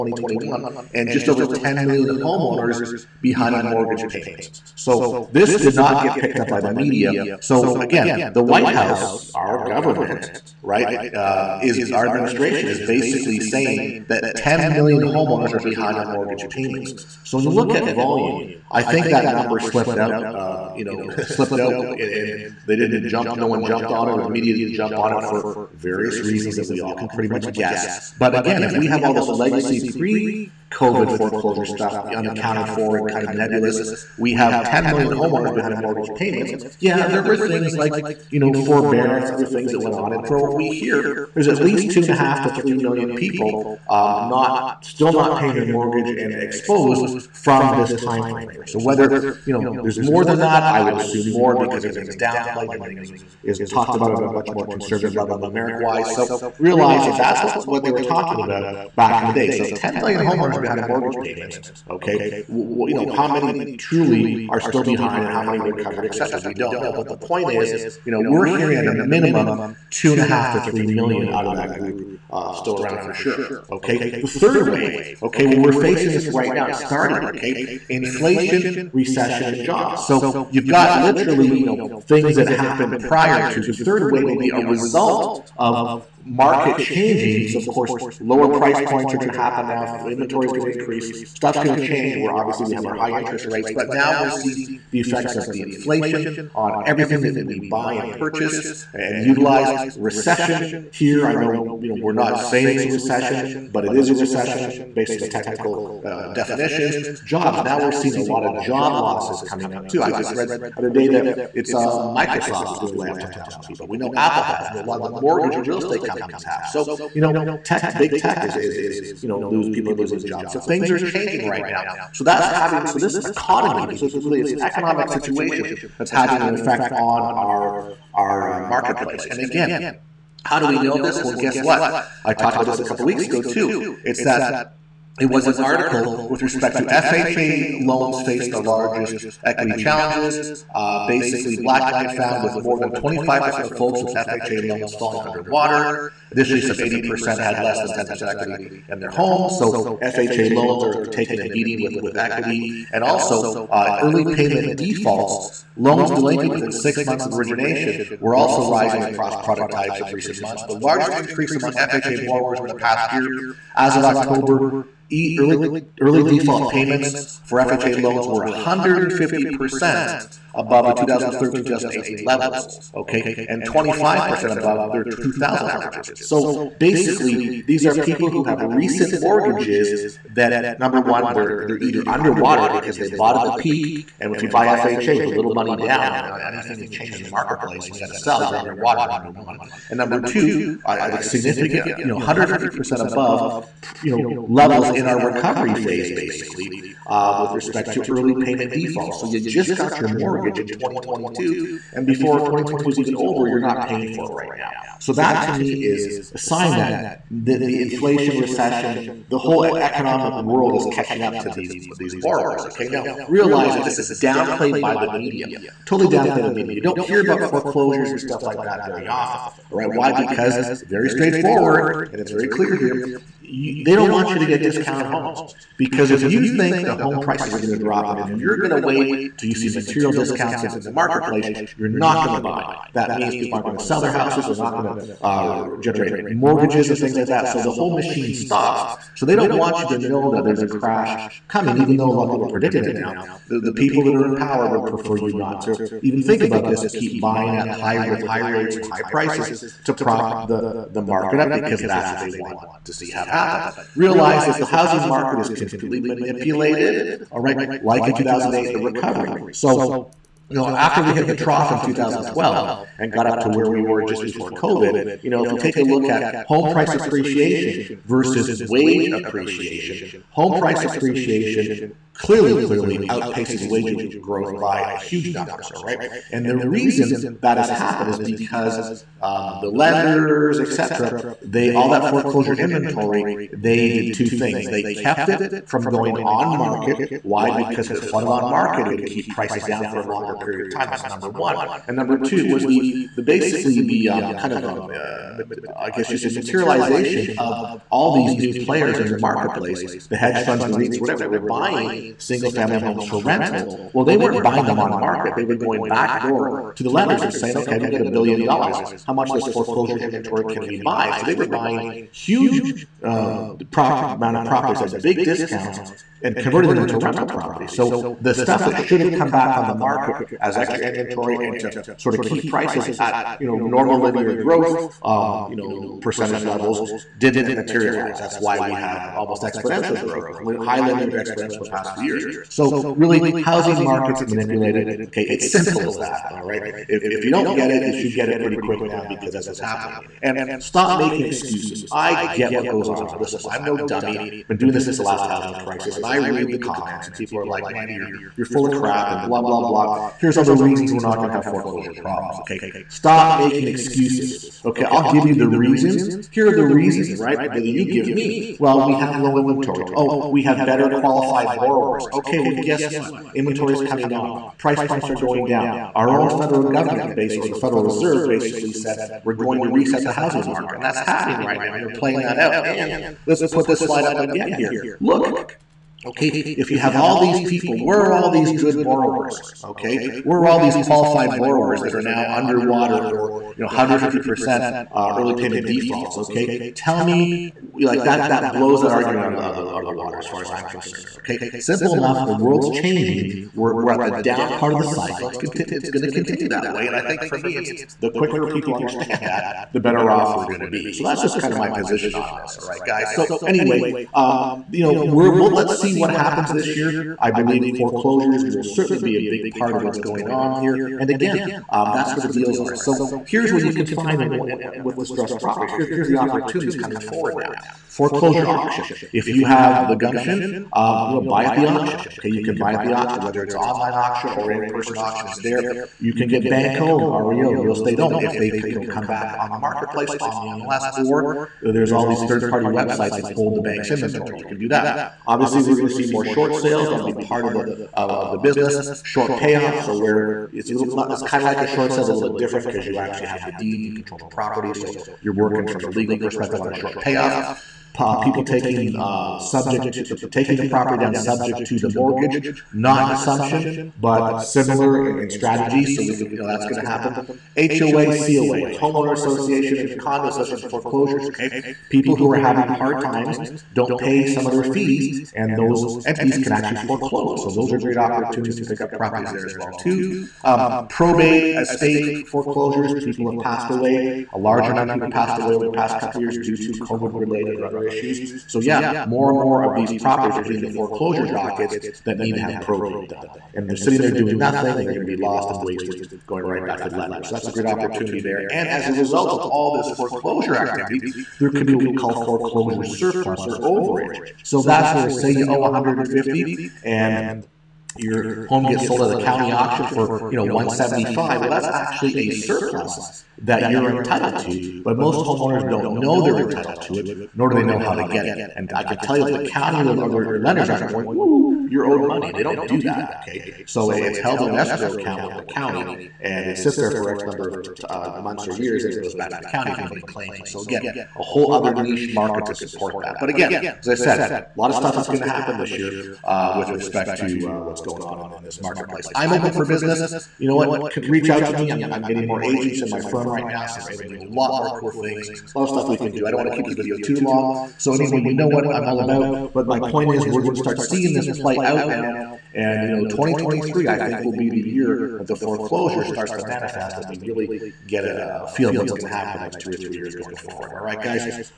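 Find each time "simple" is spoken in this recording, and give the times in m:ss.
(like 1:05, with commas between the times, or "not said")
5:35, 6:31.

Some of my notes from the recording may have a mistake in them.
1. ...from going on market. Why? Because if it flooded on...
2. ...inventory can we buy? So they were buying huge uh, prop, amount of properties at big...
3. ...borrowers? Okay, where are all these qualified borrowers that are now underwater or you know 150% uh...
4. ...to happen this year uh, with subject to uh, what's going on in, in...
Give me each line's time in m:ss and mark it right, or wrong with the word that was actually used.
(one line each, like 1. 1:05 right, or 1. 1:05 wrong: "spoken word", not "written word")
1. 4:45 right
2. 5:10 right
3. 6:18 right
4. 8:45 wrong: "respect", not "subject".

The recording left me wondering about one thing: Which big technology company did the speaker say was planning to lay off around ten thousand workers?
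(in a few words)
Microsoft.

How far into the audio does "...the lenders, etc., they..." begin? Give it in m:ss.
4:39.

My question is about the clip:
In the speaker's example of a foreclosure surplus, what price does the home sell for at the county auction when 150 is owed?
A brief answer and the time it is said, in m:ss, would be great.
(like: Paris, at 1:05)
175, at 8:20.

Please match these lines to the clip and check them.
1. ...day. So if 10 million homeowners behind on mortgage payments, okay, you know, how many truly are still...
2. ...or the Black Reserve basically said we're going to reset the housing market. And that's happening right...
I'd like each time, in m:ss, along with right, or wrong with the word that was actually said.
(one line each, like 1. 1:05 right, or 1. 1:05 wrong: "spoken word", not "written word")
1. 0:59 right
2. 6:07 wrong: "Federal", not "Black".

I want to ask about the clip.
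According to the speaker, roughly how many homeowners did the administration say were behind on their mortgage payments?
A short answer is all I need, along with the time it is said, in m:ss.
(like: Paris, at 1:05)
10 million, at 0:01.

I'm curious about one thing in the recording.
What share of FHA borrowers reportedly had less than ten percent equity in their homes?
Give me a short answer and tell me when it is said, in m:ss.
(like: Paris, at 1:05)
80%, at 2:26.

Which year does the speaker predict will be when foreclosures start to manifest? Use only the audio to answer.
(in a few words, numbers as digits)
2023.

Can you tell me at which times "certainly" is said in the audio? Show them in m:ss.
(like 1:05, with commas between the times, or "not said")
6:48.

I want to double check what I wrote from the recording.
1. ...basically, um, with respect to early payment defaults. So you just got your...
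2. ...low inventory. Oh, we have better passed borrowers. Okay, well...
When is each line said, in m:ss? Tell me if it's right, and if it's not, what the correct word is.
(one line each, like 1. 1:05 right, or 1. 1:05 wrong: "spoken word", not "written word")
1. 3:16 right
2. 5:59 wrong: "qualified", not "passed".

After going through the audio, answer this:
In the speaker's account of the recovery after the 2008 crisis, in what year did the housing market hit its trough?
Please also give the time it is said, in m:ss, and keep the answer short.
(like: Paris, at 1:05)
2012, at 4:21.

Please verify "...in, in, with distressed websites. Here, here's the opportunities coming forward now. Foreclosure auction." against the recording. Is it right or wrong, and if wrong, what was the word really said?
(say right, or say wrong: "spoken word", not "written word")
wrong: "properties", not "websites".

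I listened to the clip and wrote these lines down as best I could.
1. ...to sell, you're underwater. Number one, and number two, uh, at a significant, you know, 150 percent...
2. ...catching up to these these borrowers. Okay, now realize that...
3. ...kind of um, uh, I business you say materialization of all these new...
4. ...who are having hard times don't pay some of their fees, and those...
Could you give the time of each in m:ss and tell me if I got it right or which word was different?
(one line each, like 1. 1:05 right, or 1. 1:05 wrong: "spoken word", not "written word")
1. 3:08 right
2. 3:30 right
3. 4:54 wrong: "guess", not "business"
4. 7:42 right.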